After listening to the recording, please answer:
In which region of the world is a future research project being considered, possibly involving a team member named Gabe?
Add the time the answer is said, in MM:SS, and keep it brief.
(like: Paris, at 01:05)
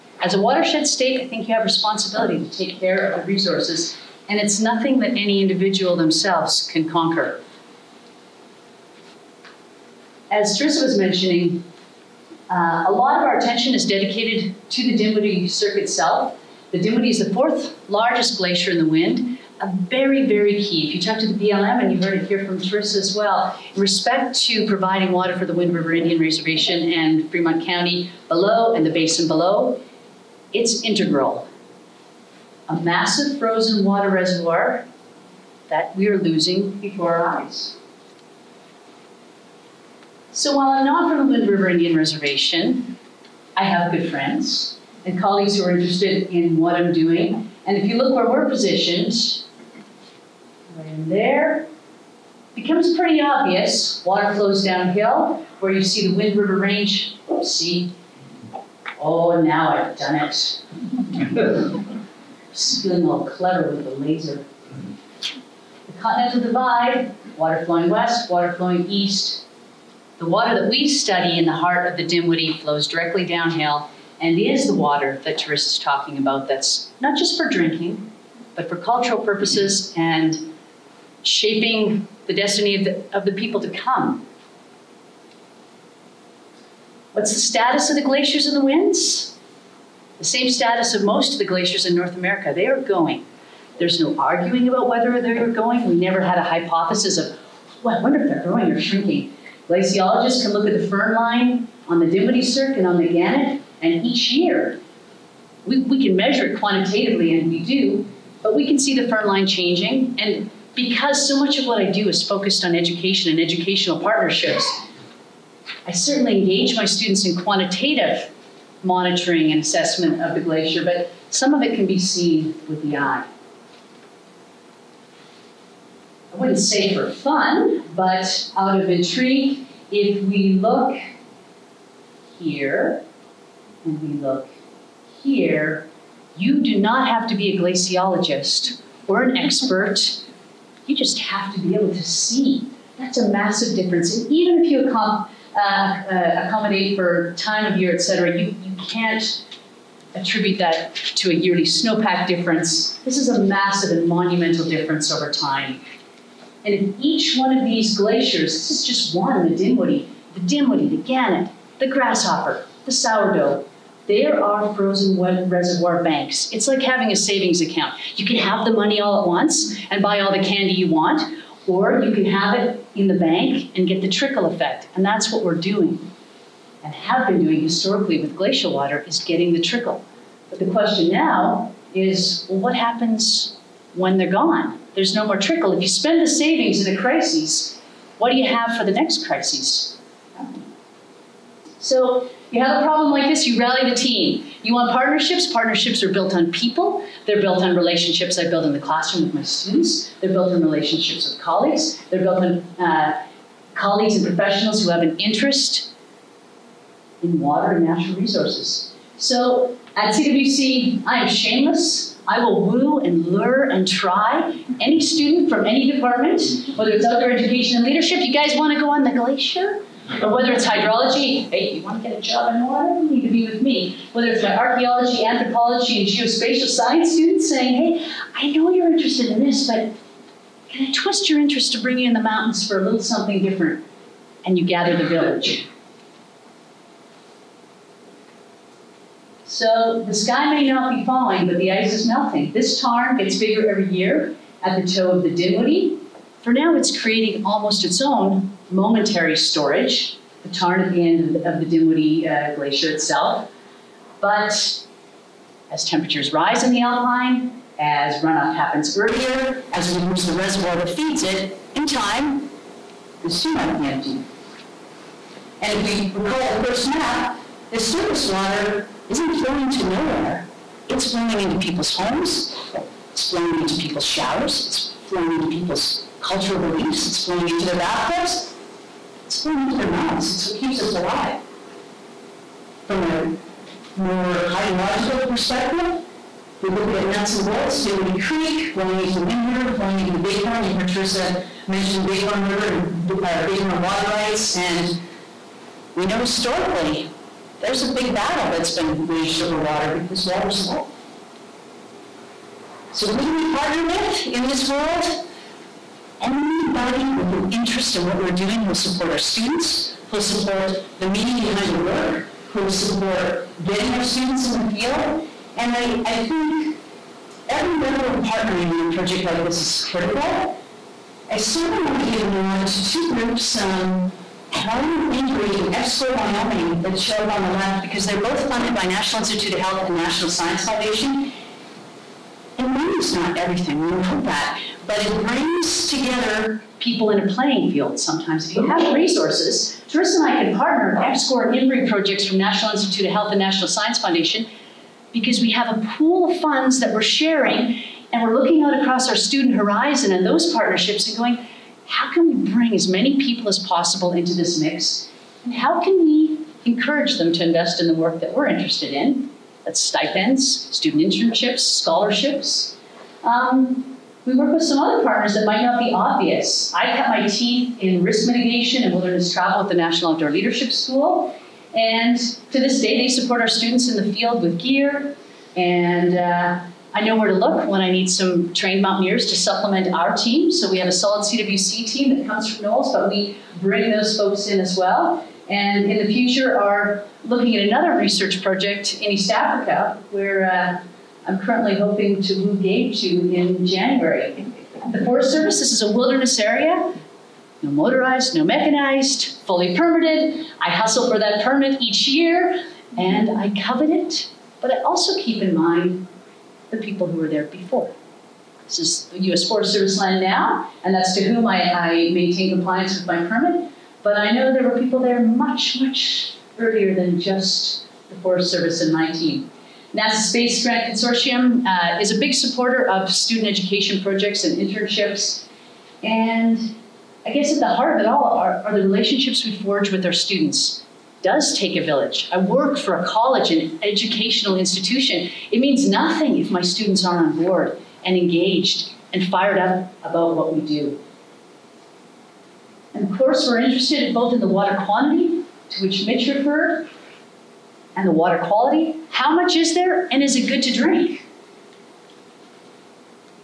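East Africa, at 06:29.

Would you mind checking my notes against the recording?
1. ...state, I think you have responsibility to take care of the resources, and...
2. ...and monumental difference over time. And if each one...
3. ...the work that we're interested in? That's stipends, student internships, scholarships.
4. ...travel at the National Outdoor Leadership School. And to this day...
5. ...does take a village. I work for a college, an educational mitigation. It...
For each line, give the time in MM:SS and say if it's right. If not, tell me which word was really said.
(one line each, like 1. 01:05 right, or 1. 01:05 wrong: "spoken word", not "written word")
1. 00:00 right
2. 02:33 right
3. 05:57 right
4. 06:09 right
5. 07:11 wrong: "institution", not "mitigation".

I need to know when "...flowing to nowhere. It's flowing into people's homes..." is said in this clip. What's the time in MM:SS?
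04:29.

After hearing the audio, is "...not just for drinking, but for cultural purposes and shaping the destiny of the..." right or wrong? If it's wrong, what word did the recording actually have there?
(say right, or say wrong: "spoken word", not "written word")
right.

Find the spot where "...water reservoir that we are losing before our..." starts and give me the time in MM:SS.
00:33.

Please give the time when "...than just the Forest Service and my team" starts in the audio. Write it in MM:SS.
06:56.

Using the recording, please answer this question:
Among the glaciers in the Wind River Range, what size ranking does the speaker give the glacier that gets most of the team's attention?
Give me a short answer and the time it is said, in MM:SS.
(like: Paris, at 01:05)
Fourth largest, at 00:17.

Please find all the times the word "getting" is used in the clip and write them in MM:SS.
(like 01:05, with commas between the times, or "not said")
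02:59, 05:13.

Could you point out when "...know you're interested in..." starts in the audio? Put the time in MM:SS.
03:48.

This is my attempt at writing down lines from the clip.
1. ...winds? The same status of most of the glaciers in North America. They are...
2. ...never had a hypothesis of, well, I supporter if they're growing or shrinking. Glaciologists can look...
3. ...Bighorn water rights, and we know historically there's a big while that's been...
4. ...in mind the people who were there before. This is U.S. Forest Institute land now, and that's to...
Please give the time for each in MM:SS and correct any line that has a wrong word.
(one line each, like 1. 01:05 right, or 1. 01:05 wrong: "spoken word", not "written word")
1. 01:28 right
2. 01:35 wrong: "wonder", not "supporter"
3. 04:53 wrong: "battle", not "while"
4. 06:45 wrong: "Service", not "Institute".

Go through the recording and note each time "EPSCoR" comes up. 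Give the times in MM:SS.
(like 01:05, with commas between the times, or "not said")
05:25, 05:41.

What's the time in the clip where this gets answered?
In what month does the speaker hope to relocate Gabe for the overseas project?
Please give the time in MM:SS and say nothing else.
06:33.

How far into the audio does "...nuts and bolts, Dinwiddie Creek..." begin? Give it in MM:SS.
04:47.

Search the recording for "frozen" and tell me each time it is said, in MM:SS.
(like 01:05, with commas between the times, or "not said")
00:33, 02:44.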